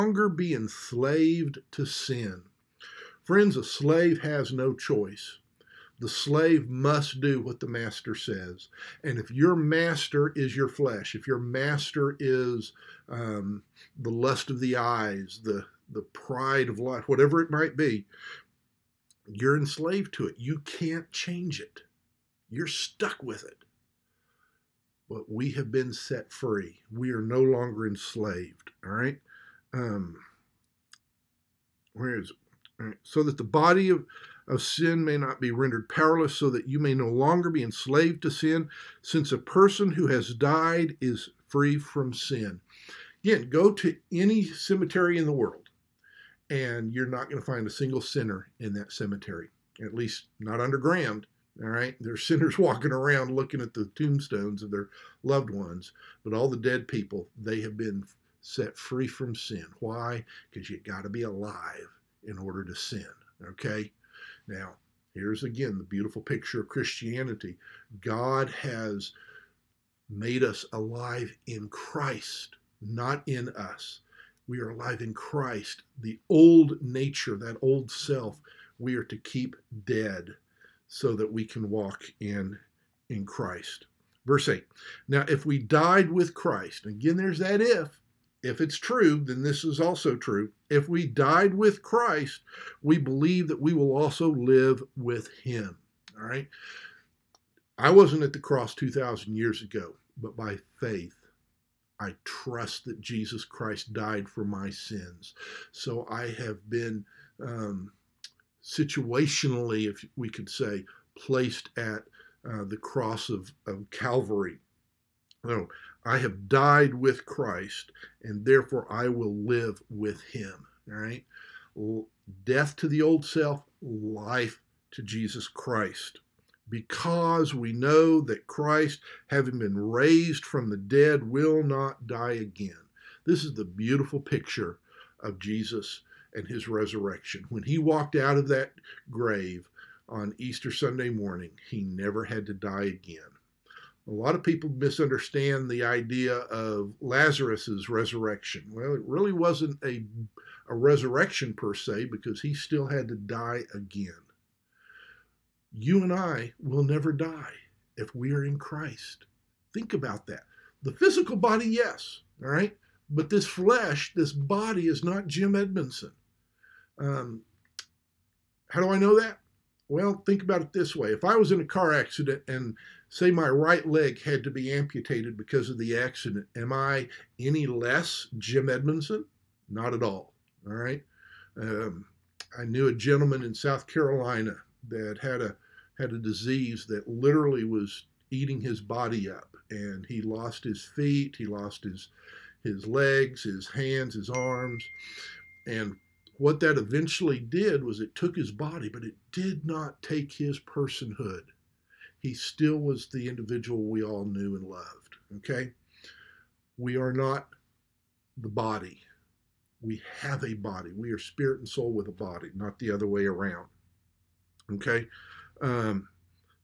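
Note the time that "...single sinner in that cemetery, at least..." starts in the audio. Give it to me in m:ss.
0:47.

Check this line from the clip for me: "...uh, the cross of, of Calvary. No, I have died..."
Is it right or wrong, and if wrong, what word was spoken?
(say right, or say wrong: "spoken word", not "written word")
right.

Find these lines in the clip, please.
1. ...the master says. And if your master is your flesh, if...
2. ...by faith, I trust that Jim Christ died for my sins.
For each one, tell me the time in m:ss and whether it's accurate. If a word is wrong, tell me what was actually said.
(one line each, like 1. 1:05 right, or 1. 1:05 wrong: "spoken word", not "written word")
1. 0:07 right
2. 1:40 wrong: "Jesus", not "Jim".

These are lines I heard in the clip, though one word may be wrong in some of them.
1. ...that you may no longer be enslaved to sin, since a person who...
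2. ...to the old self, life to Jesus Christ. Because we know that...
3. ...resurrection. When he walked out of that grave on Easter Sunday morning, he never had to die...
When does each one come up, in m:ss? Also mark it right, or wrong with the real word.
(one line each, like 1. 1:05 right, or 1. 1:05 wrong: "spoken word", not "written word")
1. 0:36 right
2. 2:02 right
3. 2:16 right.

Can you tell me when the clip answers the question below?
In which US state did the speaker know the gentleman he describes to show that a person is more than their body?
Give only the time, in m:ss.
3:03.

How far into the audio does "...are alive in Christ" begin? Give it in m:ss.
1:14.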